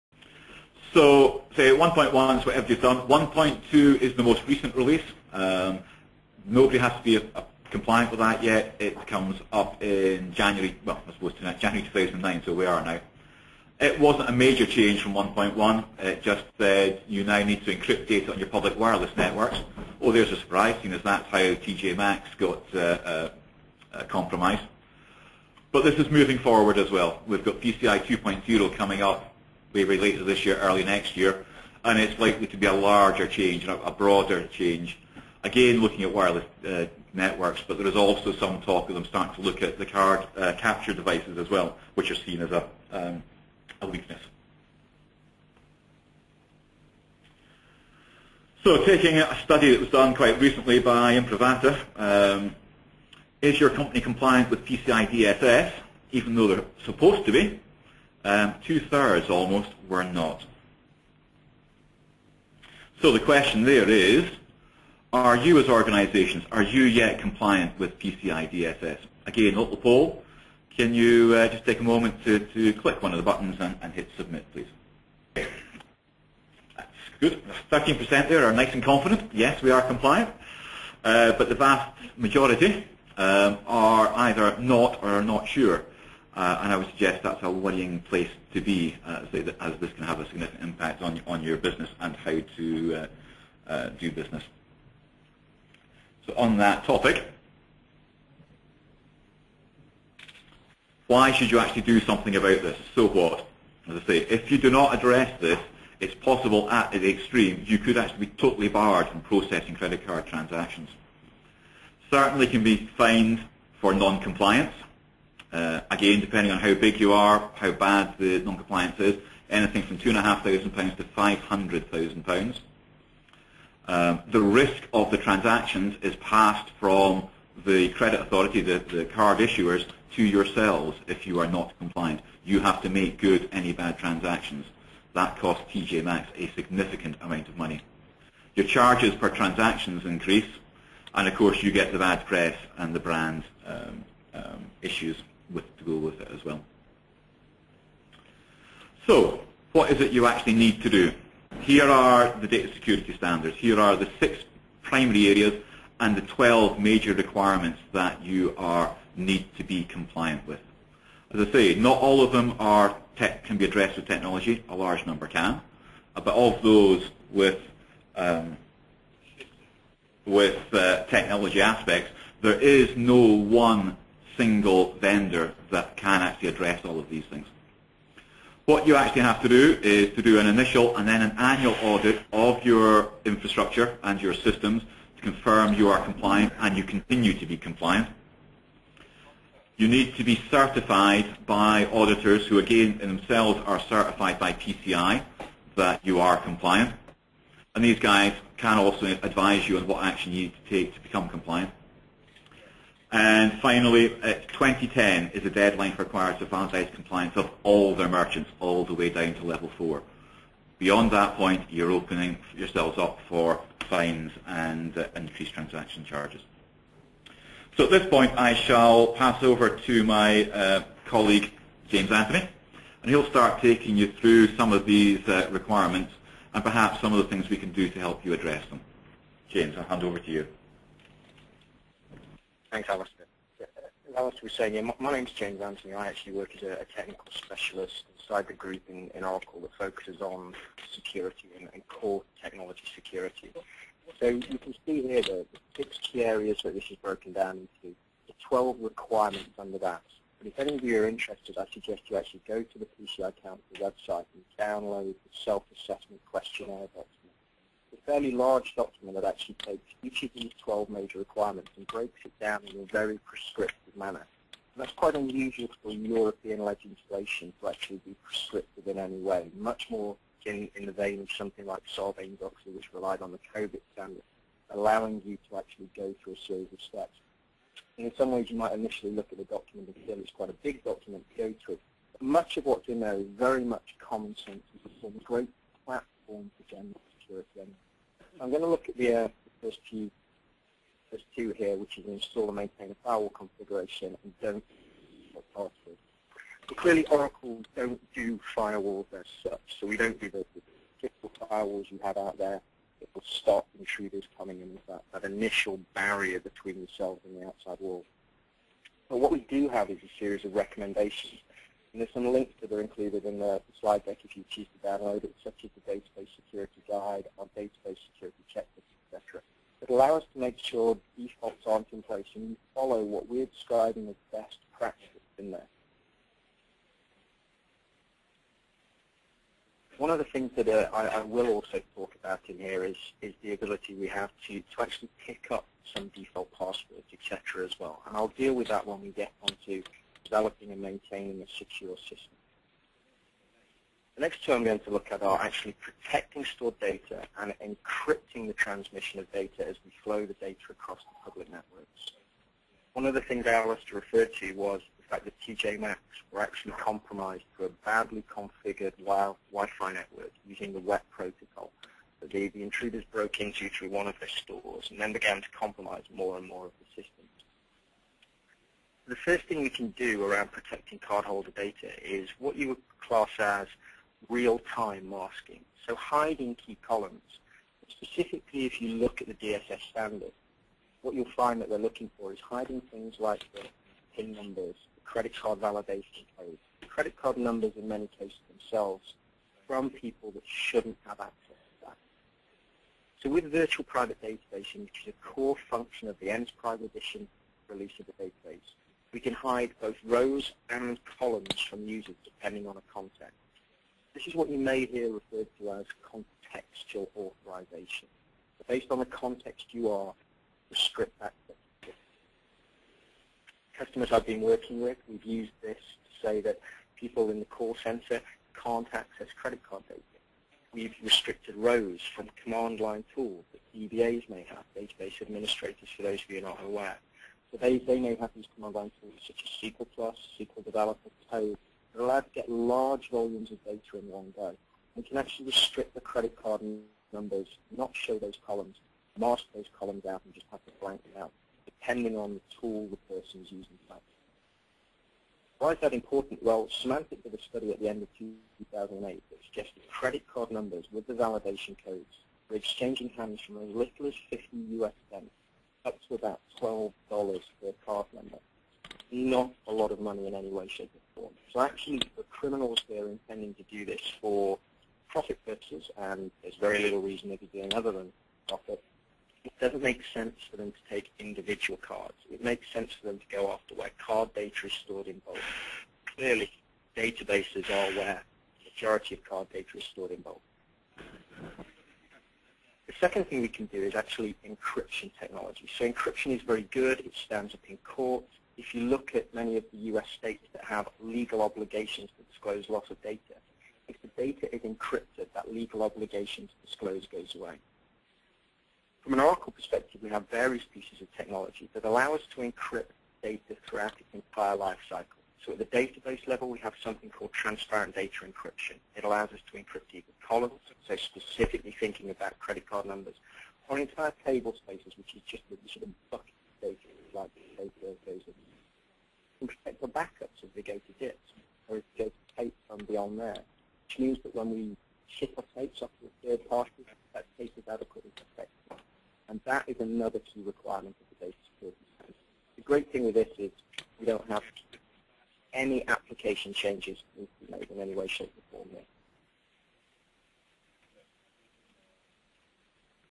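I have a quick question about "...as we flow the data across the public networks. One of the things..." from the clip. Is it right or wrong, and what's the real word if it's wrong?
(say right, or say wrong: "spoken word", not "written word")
right.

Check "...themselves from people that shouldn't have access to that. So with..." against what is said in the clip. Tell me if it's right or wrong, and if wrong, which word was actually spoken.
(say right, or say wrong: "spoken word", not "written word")
right.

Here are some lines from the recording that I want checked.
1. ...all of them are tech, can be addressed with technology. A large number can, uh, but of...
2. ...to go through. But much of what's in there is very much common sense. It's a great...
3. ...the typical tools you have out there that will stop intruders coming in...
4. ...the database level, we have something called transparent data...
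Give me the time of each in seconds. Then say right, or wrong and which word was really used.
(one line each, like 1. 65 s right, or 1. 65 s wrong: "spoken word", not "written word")
1. 162 s right
2. 281 s right
3. 300 s wrong: "firewalls", not "tools"
4. 505 s right.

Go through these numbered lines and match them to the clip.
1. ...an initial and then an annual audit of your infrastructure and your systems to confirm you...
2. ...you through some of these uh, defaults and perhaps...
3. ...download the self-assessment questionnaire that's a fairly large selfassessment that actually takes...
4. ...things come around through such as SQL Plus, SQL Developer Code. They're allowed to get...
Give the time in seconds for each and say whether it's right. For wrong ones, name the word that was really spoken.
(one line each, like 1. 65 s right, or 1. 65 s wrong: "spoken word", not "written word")
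1. 180 s right
2. 223 s wrong: "requirements", not "defaults"
3. 254 s wrong: "document", not "selfassessment"
4. 428 s right.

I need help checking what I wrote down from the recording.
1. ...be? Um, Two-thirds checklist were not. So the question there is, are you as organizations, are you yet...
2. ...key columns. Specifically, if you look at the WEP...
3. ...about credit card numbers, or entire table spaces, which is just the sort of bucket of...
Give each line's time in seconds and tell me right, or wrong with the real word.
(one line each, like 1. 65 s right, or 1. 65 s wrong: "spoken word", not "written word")
1. 57 s wrong: "almost", not "checklist"
2. 376 s wrong: "DSS", not "WEP"
3. 512 s right.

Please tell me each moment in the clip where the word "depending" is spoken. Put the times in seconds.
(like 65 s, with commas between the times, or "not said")
116 s, 402 s, 441 s.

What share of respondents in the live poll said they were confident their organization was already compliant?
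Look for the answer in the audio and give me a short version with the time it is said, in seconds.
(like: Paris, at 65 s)
13%, at 77 s.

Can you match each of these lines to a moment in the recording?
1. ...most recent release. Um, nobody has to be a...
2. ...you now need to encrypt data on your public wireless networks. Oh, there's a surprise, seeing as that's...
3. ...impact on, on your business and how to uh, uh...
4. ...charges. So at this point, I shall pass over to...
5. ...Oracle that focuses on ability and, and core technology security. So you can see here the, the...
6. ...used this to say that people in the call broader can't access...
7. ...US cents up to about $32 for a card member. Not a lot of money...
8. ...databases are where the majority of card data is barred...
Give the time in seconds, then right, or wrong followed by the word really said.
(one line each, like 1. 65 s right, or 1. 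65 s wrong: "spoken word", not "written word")
1. 4 s right
2. 17 s right
3. 90 s right
4. 216 s right
5. 239 s wrong: "security", not "ability"
6. 415 s wrong: "center", not "broader"
7. 454 s wrong: "12", not "32"
8. 476 s wrong: "stored", not "barred".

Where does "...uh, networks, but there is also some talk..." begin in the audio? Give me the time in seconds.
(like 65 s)
36 s.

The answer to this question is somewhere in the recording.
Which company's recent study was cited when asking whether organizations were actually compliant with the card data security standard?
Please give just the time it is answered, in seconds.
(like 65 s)
51 s.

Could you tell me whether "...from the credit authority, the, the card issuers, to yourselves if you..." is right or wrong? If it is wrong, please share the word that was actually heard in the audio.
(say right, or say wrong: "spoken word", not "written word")
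right.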